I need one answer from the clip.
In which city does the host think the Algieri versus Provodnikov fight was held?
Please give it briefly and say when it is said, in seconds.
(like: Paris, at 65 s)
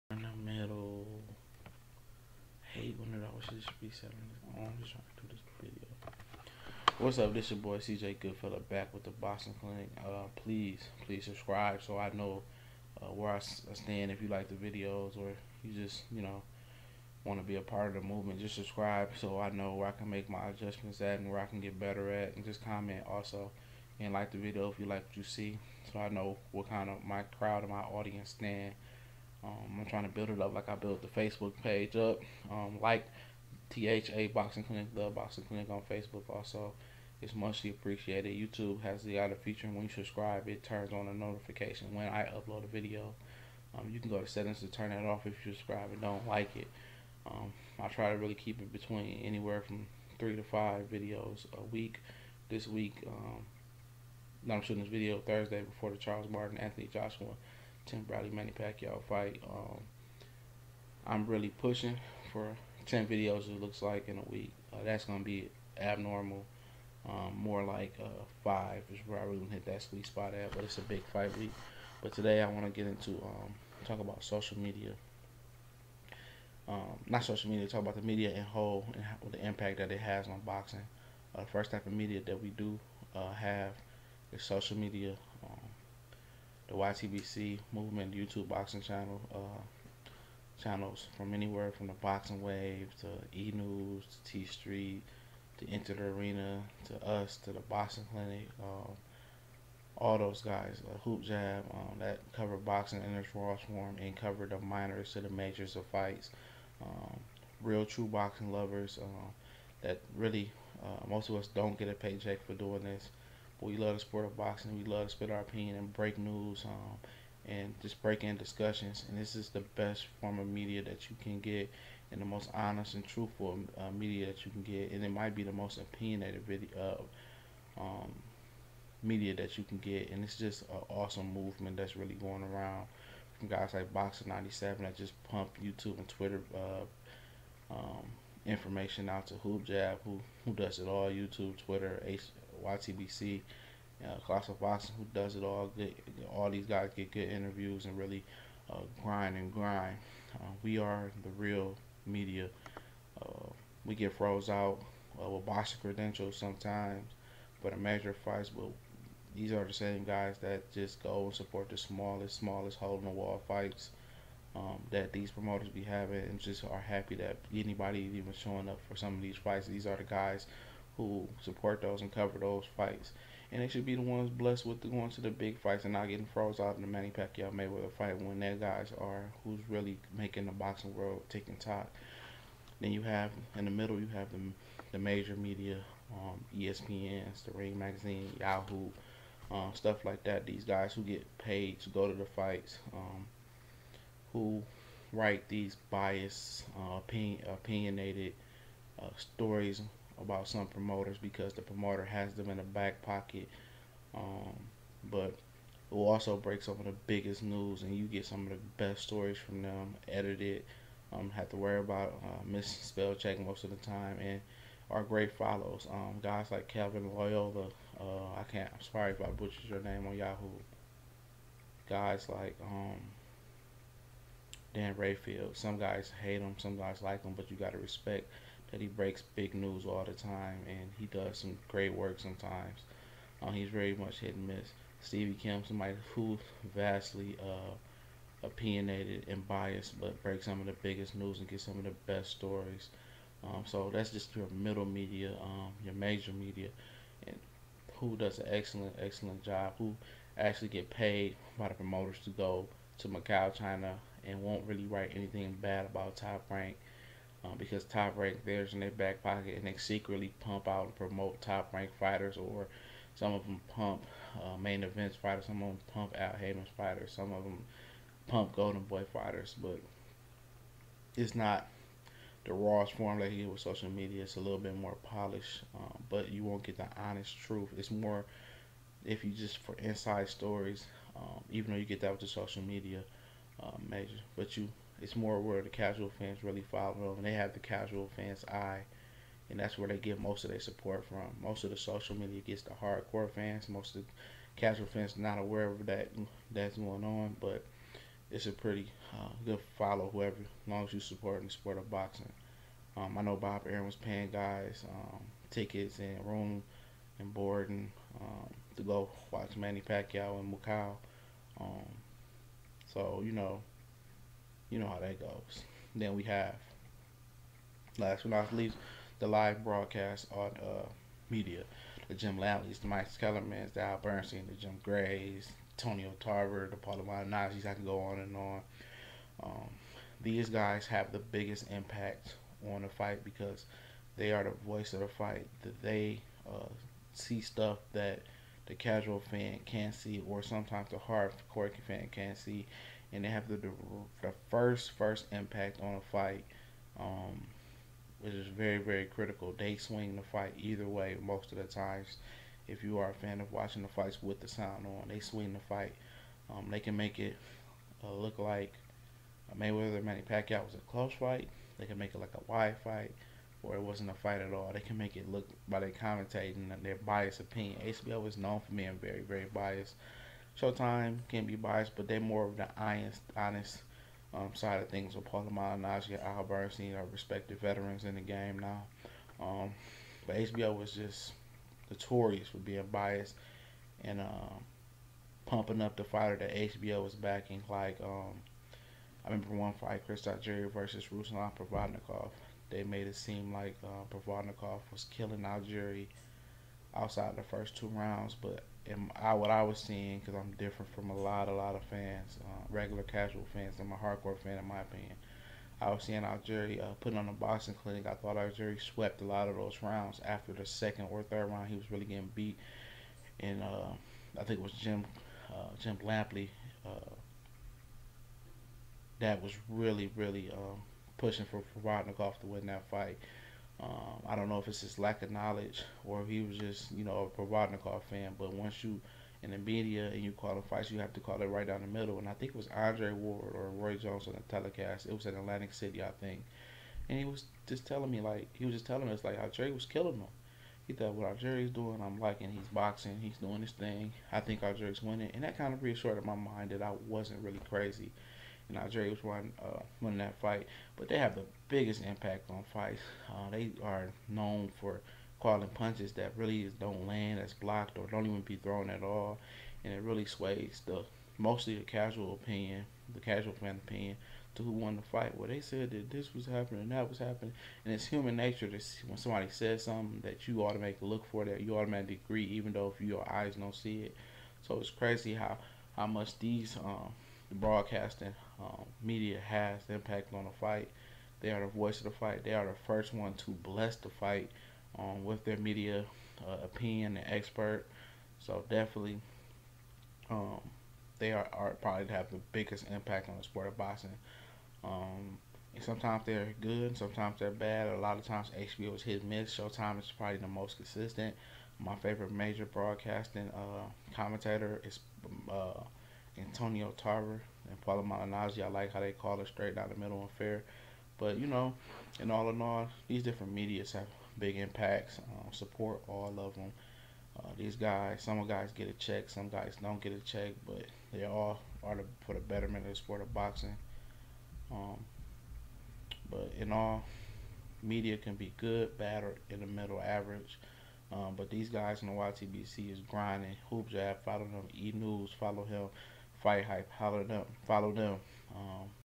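Atlantic City, at 435 s.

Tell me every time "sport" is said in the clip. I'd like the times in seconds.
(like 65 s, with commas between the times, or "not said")
113 s, 301 s, 493 s, 522 s.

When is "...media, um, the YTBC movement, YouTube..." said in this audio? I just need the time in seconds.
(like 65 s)
84 s.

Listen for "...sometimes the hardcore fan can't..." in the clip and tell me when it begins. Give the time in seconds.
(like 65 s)
340 s.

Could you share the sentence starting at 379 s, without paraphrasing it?
Um, but HBO was just notorious for being biased and um, pumping up the fighter that HBO was backing.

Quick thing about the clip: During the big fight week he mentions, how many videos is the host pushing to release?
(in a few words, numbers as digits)
10.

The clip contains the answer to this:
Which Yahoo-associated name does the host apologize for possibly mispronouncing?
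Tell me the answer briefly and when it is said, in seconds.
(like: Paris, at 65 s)
Calvin Loyola, at 216 s.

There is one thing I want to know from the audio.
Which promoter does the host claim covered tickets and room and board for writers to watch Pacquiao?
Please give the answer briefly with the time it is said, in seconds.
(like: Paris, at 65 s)
Bob Arum, at 303 s.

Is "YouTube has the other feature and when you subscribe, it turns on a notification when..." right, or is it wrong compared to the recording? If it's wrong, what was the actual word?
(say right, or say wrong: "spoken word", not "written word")
right.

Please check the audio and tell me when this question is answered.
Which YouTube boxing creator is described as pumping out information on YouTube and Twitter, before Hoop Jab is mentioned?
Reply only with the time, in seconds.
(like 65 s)
133 s.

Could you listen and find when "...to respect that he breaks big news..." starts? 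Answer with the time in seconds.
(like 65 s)
227 s.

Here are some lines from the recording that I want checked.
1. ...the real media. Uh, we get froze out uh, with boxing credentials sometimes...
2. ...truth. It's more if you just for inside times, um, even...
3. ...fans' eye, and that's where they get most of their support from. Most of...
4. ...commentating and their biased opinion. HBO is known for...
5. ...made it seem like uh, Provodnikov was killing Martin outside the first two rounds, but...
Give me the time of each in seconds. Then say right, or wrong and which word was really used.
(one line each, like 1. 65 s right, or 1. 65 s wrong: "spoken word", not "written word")
1. 151 s right
2. 277 s wrong: "stories", not "times"
3. 288 s right
4. 365 s right
5. 392 s wrong: "Algieri", not "Martin".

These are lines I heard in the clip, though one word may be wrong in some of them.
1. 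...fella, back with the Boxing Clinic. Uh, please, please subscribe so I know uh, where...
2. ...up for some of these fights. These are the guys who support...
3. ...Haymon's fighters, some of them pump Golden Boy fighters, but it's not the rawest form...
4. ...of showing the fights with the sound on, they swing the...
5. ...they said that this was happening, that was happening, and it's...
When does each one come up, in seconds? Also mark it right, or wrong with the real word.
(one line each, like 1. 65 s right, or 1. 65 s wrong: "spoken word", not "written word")
1. 8 s right
2. 168 s right
3. 266 s right
4. 353 s wrong: "watching", not "showing"
5. 465 s right.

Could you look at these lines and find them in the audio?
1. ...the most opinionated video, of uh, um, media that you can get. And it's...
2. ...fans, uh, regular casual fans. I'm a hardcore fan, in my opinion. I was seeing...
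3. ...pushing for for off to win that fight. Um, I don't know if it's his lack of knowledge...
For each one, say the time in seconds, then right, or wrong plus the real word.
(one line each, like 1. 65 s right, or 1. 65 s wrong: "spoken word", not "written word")
1. 125 s right
2. 401 s right
3. 421 s right.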